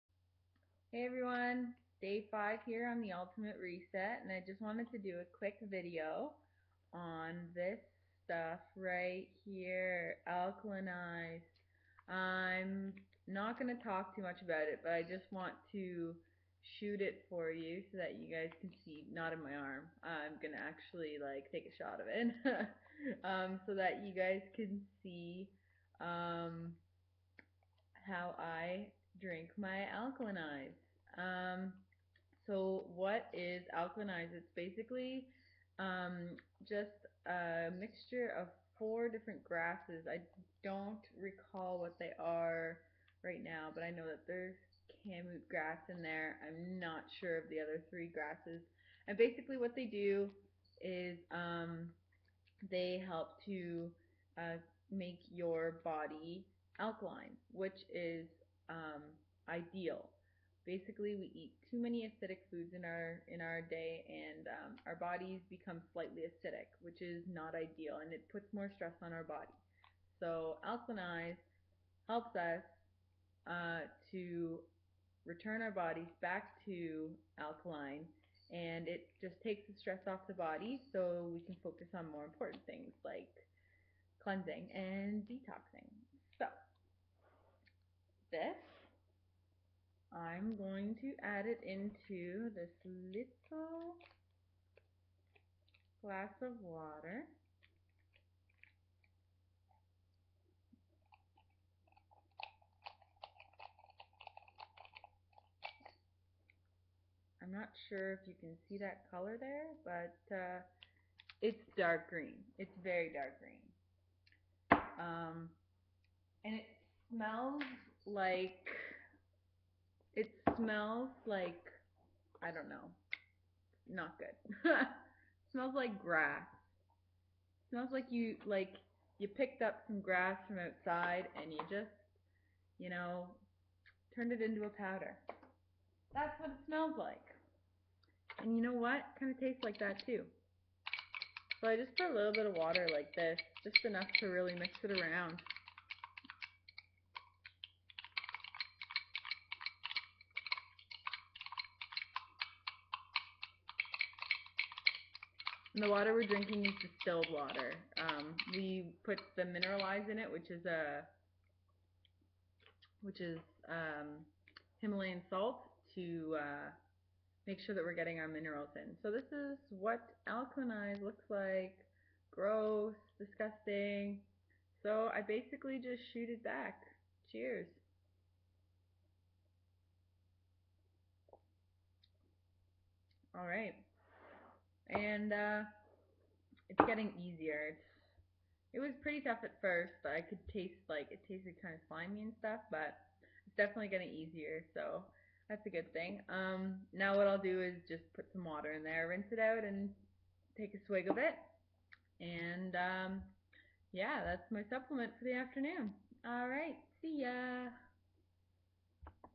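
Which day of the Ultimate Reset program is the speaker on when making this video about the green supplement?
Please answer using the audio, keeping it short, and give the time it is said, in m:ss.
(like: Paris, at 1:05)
Day 5, at 0:02.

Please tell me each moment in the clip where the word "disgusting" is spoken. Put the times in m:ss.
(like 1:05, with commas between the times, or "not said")
2:53.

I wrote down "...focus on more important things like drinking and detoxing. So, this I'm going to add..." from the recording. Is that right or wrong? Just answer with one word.
wrong.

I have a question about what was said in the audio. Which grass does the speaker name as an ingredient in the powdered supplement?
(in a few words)
Kamut grass.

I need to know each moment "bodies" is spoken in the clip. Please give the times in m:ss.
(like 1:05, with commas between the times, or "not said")
1:04, 1:15.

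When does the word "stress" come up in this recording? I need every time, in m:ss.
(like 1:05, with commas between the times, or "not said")
1:08, 1:19.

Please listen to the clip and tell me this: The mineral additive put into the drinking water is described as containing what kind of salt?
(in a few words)
Himalayan salt.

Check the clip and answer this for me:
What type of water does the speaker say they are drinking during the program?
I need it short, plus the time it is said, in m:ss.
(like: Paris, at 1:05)
Distilled water, at 2:36.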